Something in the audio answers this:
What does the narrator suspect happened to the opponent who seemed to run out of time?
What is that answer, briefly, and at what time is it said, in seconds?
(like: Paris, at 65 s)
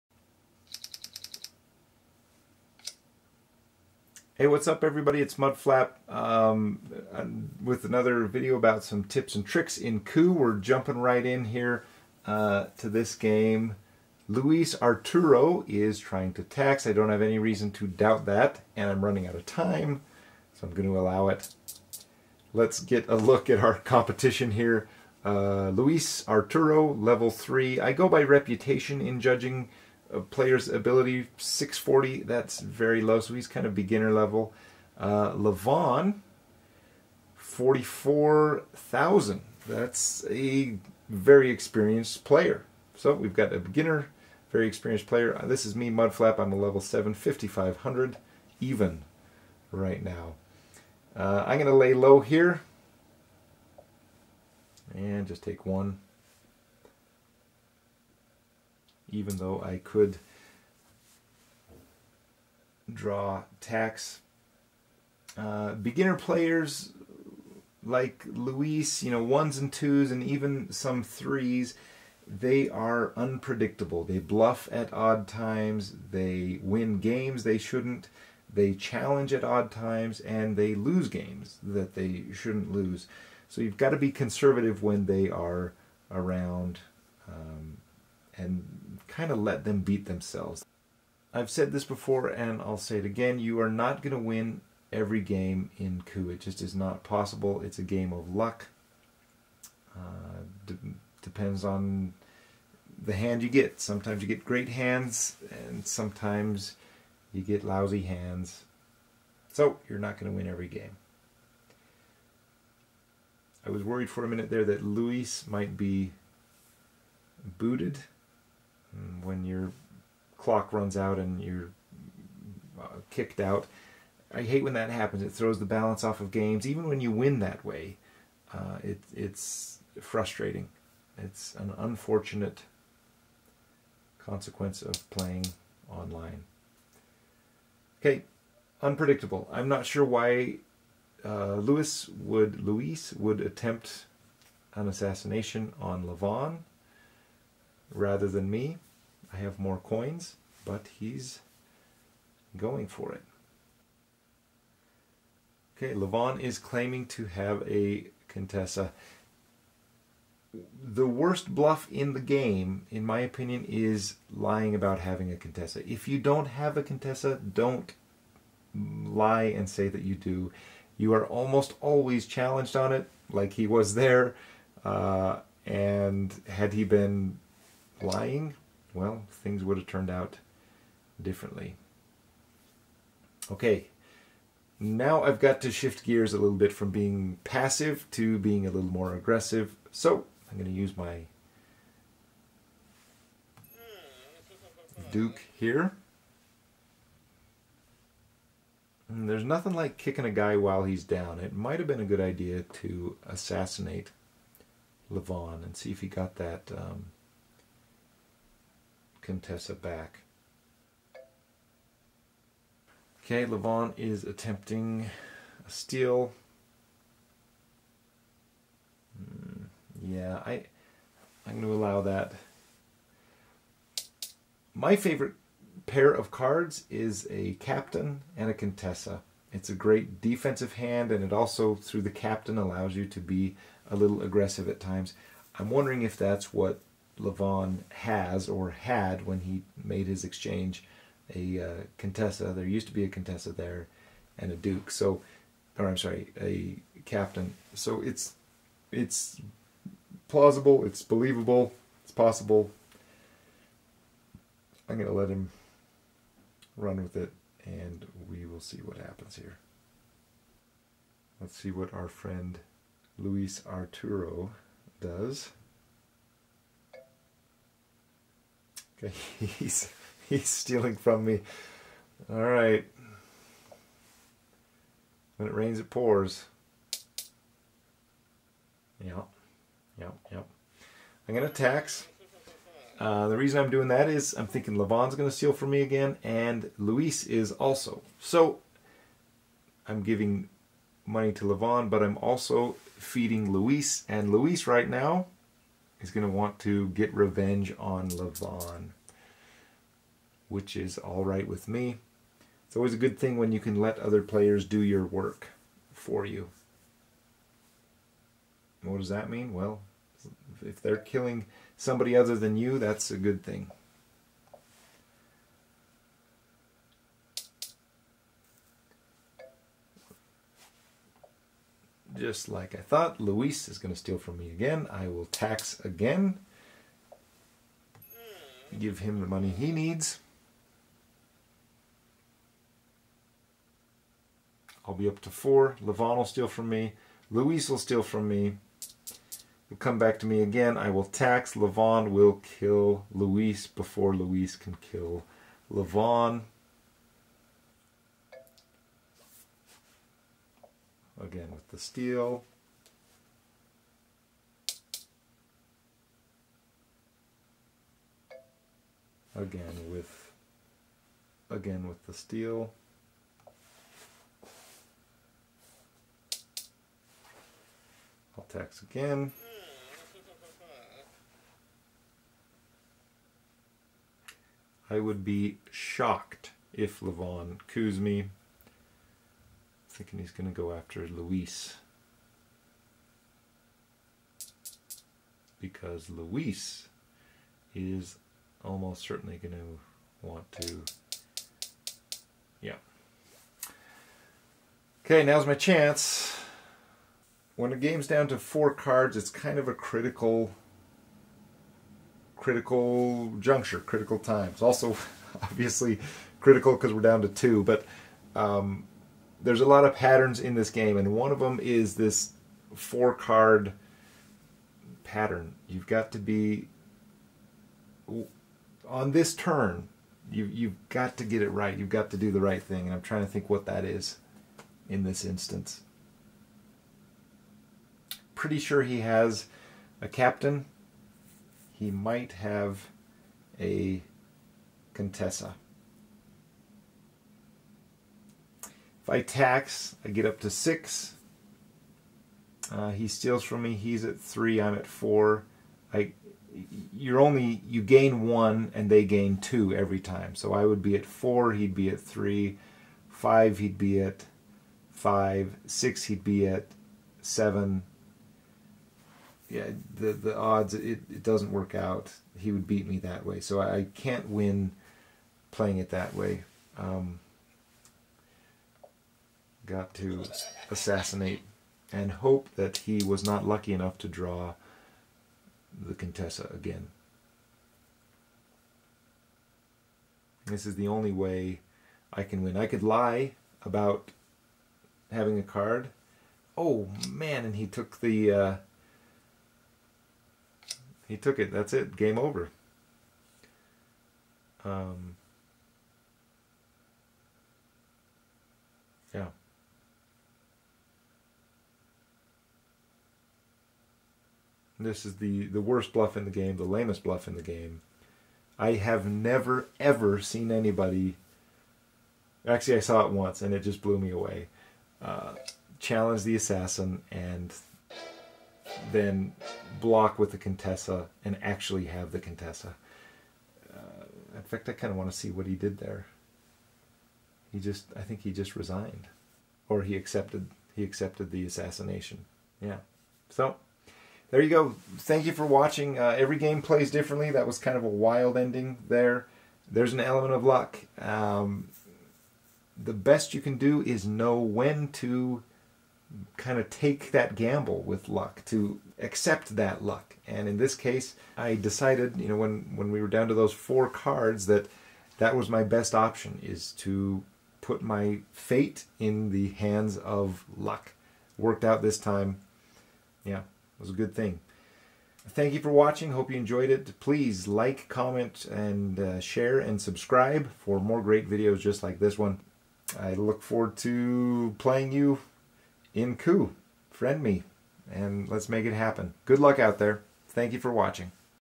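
booted, at 117 s.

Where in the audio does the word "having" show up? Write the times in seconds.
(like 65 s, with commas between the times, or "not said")
164 s, 485 s.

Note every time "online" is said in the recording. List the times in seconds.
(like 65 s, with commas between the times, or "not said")
135 s.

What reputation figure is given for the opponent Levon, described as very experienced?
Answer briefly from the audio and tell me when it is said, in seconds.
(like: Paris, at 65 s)
44,000, at 37 s.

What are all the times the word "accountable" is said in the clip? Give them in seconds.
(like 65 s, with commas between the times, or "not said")
not said.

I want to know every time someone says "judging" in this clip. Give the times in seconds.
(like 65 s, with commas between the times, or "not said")
29 s.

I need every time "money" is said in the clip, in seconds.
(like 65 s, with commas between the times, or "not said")
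291 s, 329 s.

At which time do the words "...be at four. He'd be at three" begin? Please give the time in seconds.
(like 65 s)
450 s.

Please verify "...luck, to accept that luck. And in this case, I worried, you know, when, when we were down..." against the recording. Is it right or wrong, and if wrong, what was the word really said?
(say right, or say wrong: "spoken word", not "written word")
wrong: "decided", not "worried".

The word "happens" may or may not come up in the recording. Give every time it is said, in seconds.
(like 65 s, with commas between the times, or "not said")
124 s, 258 s, 578 s.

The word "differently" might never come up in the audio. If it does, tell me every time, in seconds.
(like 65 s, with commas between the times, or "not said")
181 s, 536 s.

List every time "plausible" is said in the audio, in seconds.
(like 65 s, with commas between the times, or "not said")
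250 s.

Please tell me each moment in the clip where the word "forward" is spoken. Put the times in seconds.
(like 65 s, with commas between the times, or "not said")
573 s.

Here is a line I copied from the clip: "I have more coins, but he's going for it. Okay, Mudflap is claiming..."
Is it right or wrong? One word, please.
wrong.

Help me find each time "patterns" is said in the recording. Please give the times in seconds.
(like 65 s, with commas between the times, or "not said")
409 s, 415 s.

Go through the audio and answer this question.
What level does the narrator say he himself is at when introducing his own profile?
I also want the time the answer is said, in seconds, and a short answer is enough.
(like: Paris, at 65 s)
7, at 46 s.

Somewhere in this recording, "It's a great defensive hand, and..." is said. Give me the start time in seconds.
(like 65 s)
229 s.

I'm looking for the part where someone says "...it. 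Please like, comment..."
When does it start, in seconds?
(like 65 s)
566 s.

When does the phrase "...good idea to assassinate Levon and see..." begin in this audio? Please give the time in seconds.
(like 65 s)
202 s.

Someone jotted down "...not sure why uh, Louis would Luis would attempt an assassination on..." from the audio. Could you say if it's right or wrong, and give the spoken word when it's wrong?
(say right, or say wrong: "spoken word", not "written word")
right.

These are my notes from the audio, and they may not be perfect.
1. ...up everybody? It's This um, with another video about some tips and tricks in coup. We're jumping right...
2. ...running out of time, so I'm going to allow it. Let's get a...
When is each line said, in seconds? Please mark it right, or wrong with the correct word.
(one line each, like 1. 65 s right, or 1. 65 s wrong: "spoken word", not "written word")
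1. 4 s wrong: "Mudflap", not "This"
2. 19 s right.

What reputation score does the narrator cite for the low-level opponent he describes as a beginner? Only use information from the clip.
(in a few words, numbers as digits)
640.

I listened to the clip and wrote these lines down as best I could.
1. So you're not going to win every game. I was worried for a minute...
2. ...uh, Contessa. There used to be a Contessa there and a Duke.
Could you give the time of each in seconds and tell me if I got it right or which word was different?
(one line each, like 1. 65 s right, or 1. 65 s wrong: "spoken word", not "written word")
1. 109 s right
2. 241 s right.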